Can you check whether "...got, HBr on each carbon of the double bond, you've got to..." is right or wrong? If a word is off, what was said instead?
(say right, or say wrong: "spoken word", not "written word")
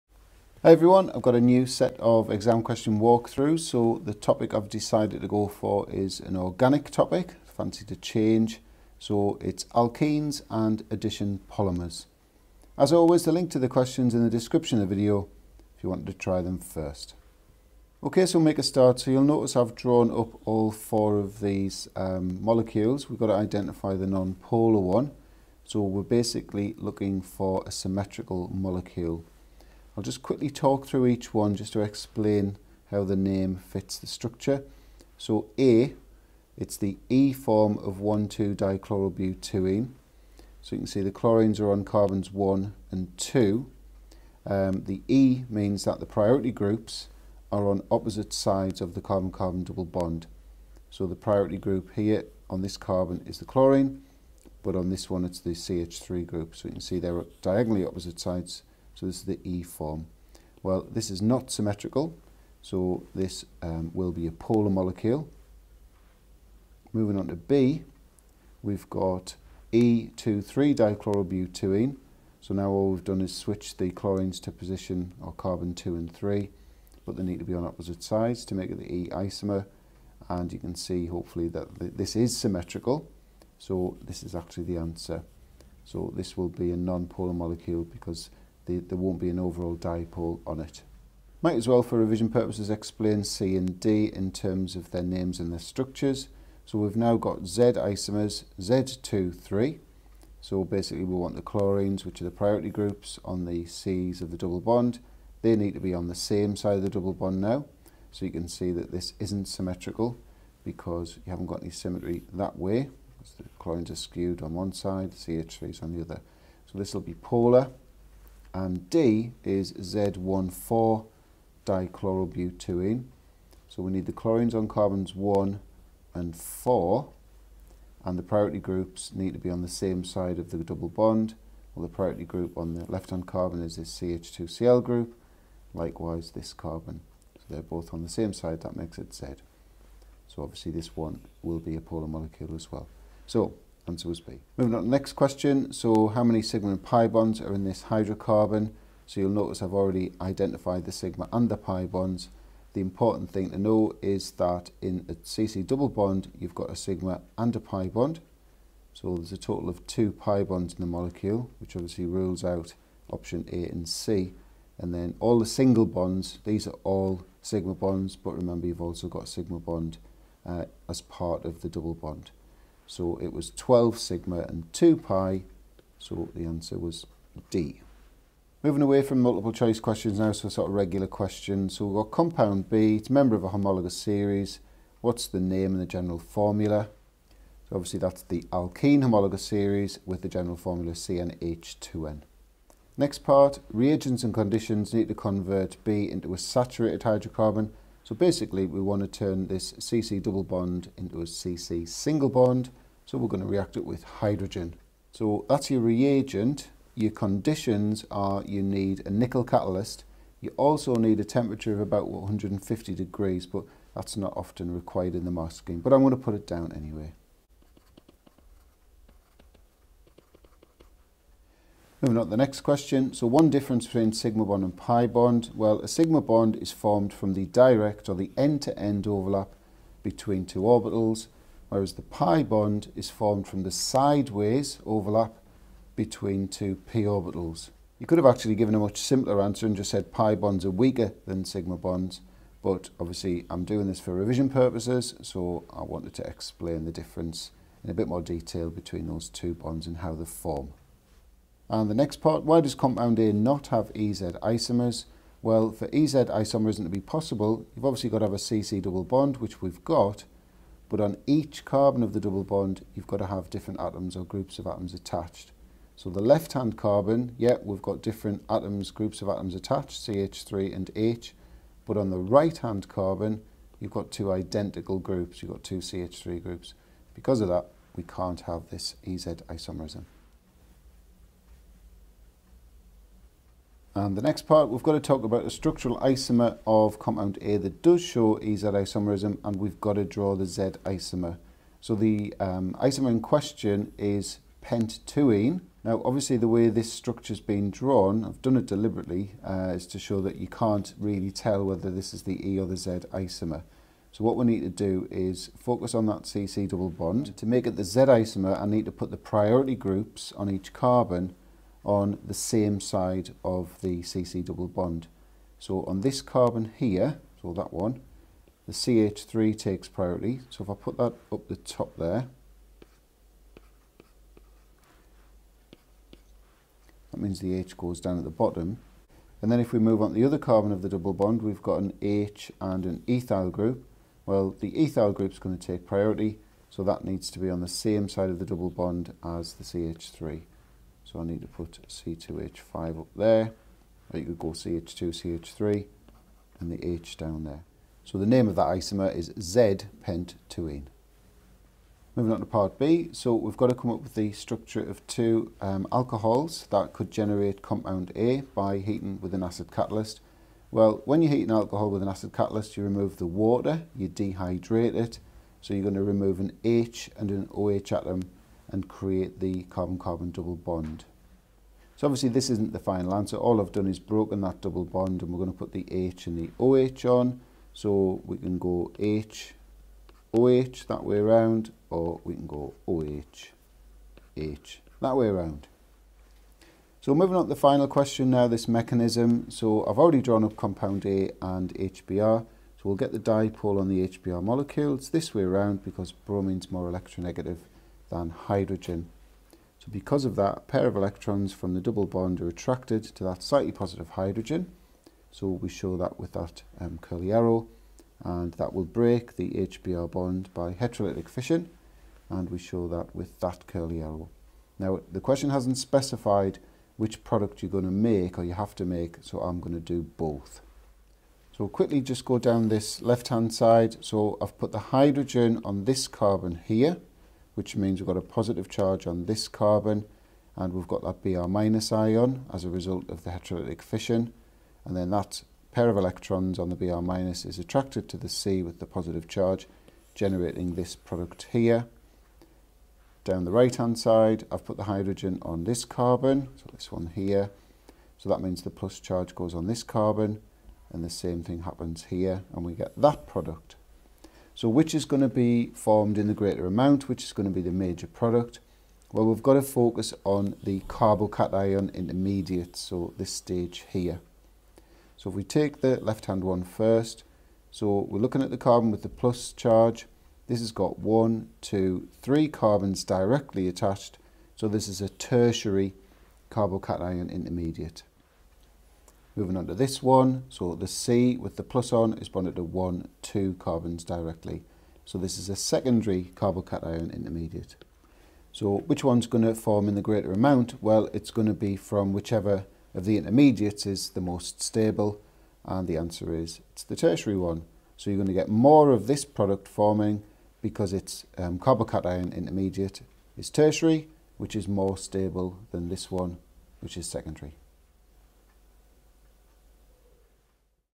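wrong: "But", not "HBr".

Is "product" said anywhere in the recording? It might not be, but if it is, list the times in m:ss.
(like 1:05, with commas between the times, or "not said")
6:57, 7:20, 7:33, 7:38, 8:19.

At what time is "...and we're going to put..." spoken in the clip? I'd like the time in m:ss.
6:15.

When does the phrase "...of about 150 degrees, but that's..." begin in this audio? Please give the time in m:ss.
3:31.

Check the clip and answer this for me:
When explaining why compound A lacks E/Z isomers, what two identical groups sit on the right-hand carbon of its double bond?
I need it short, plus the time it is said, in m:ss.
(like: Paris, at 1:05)
two CH3 groups, at 4:35.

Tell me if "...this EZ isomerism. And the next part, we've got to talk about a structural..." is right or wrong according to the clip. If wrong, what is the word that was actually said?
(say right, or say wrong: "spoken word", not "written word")
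right.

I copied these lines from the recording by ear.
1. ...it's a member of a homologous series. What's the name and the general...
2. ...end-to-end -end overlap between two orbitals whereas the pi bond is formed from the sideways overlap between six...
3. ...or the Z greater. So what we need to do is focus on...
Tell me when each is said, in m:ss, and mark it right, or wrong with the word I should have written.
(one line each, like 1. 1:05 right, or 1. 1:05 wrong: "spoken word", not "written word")
1. 3:02 right
2. 3:48 wrong: "two", not "six"
3. 5:02 wrong: "isomer", not "greater".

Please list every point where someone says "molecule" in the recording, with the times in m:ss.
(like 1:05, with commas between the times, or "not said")
0:22, 0:28, 1:04, 1:27, 2:22, 2:40, 6:34.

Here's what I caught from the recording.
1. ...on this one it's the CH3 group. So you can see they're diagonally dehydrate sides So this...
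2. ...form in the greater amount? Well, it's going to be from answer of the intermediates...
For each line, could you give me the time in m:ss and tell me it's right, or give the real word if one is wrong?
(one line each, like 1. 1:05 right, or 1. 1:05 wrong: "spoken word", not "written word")
1. 0:54 wrong: "opposite", not "dehydrate"
2. 8:09 wrong: "whichever", not "answer".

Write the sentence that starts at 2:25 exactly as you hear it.
So how many sigma and pi bonds are in this hydrocarbon?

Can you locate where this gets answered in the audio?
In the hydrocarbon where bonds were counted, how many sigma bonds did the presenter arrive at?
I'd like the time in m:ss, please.
2:53.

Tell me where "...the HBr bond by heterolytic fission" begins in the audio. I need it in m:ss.
6:49.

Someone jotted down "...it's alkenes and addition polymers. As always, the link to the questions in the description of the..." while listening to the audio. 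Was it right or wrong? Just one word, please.
right.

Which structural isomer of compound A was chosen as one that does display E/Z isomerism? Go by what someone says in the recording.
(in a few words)
pent-2-ene.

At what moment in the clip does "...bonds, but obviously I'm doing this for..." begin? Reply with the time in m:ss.
4:01.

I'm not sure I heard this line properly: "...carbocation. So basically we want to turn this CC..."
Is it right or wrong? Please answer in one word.
wrong.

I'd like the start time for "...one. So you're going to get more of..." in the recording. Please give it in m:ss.
8:17.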